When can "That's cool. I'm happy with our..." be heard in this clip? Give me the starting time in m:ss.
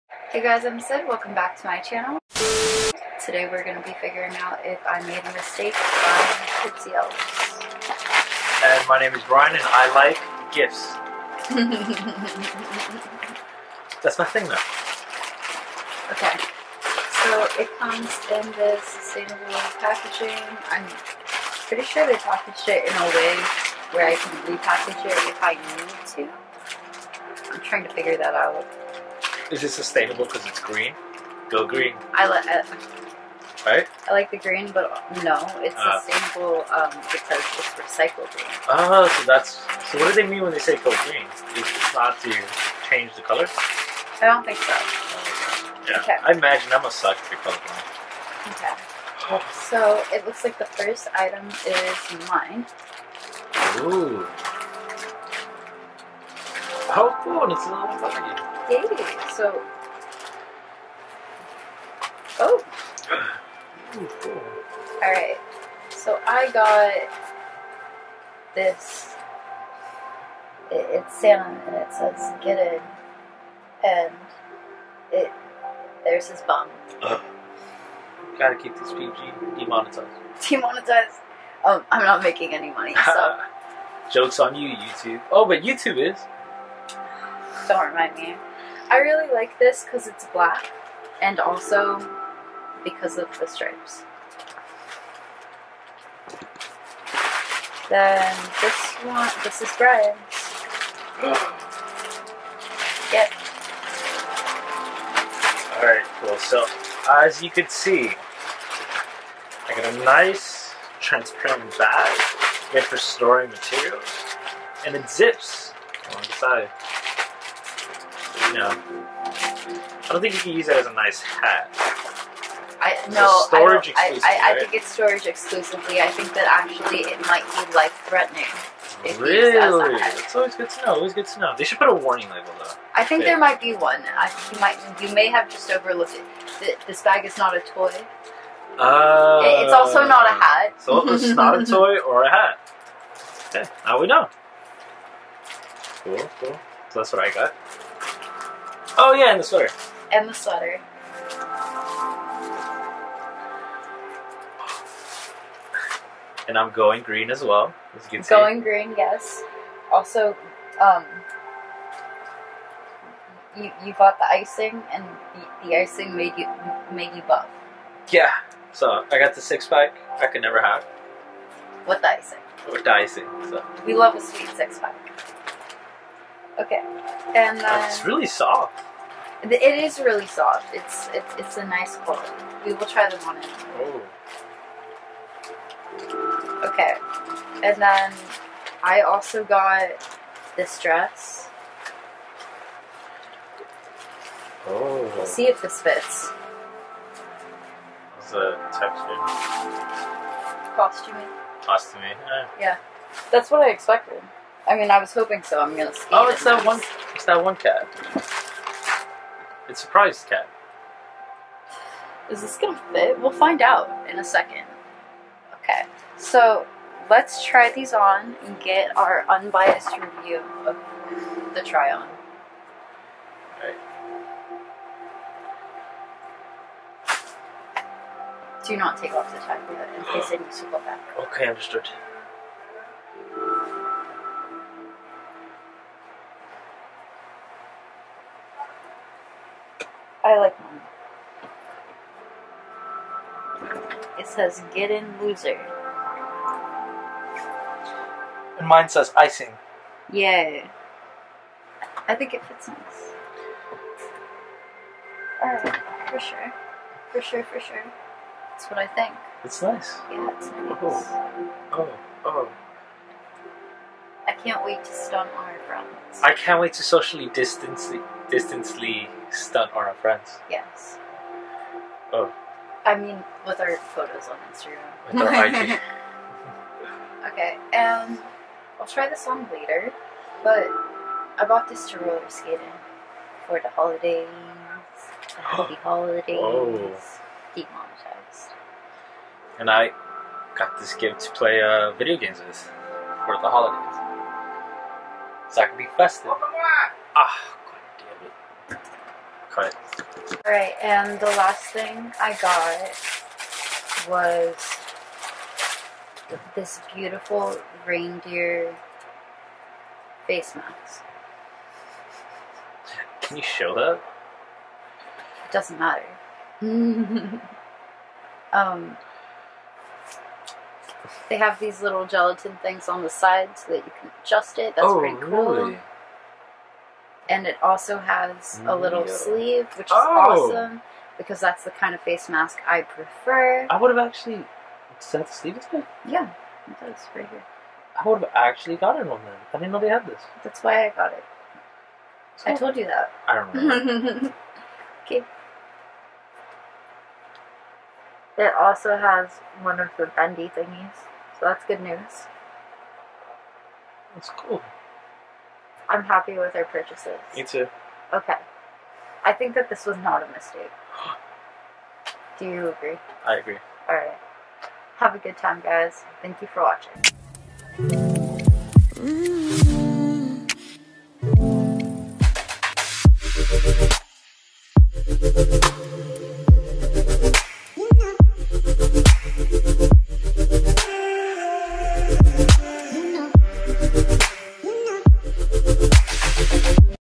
5:54.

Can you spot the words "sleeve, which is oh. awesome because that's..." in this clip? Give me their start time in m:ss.
5:29.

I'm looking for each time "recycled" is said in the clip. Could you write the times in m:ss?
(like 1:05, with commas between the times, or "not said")
0:37.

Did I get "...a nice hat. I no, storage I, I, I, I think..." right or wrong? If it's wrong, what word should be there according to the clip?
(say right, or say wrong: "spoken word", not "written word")
right.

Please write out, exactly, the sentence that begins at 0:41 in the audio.
It's not to change the color.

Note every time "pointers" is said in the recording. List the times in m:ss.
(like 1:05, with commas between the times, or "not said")
not said.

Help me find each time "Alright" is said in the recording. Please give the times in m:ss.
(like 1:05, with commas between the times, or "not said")
1:45, 4:15, 5:00.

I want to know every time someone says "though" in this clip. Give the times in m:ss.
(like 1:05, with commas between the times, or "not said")
0:14, 2:12.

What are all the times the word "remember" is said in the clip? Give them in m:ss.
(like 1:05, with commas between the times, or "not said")
5:43.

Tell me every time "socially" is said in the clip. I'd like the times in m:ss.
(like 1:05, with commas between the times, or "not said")
4:26.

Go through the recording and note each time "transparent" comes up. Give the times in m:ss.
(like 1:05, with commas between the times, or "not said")
1:50.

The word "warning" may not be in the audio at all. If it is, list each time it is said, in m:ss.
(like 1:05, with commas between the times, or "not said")
2:11.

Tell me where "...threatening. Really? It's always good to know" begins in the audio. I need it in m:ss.
2:08.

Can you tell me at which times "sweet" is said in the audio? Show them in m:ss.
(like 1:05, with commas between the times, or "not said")
2:54.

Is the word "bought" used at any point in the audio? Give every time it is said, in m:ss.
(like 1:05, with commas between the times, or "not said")
2:43, 4:41.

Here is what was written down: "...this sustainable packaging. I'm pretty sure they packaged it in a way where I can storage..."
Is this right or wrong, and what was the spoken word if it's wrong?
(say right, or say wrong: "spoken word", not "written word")
wrong: "repackage", not "storage".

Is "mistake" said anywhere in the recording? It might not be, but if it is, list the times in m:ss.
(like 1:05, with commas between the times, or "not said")
0:05, 6:00.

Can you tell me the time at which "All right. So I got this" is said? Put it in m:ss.
1:05.